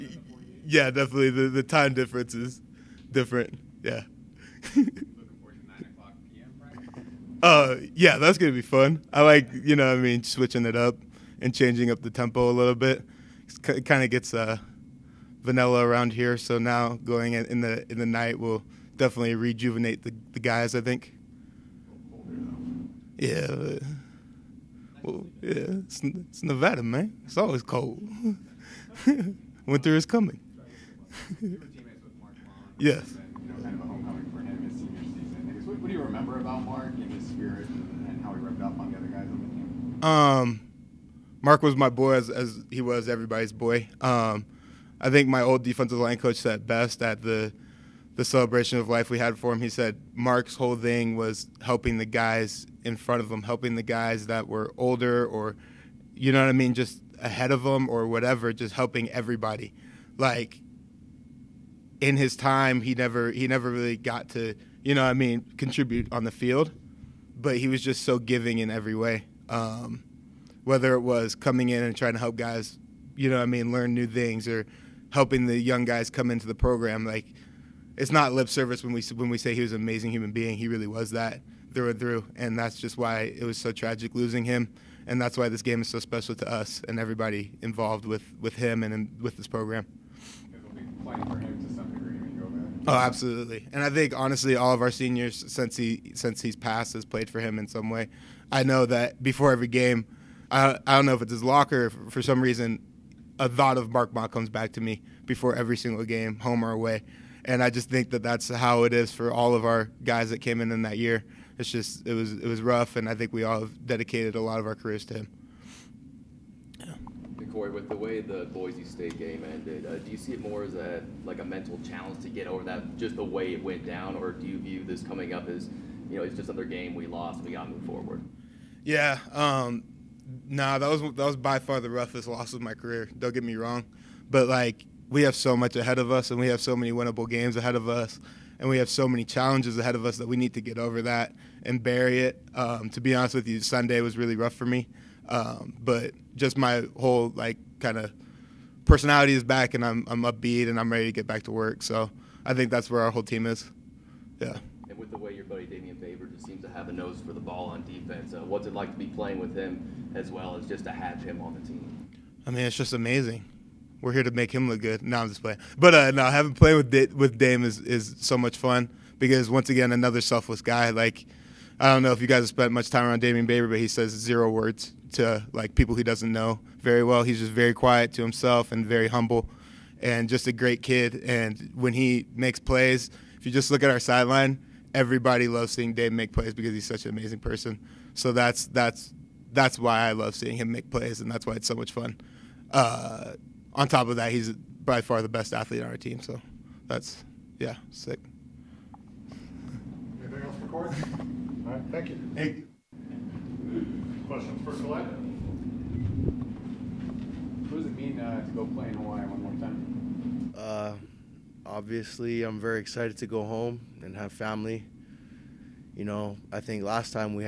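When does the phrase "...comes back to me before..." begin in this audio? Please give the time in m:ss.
1:44.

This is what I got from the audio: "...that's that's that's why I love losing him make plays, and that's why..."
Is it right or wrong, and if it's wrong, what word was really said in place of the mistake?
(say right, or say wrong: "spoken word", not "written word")
wrong: "seeing", not "losing".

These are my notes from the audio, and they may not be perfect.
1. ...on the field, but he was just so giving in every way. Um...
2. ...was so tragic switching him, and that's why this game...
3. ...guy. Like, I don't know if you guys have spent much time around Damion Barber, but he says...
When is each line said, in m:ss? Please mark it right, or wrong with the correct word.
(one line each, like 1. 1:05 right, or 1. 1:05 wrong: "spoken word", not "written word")
1. 1:06 right
2. 1:23 wrong: "losing", not "switching"
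3. 2:50 right.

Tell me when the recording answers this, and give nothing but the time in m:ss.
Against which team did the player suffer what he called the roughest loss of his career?
1:58.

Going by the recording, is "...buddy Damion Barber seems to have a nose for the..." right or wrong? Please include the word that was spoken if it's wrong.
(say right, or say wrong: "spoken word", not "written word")
right.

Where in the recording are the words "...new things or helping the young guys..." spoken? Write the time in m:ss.
1:13.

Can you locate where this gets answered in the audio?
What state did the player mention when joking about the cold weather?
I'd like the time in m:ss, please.
0:26.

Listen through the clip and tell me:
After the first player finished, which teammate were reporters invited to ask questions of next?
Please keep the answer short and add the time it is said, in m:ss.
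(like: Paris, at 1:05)
Kalei, at 3:24.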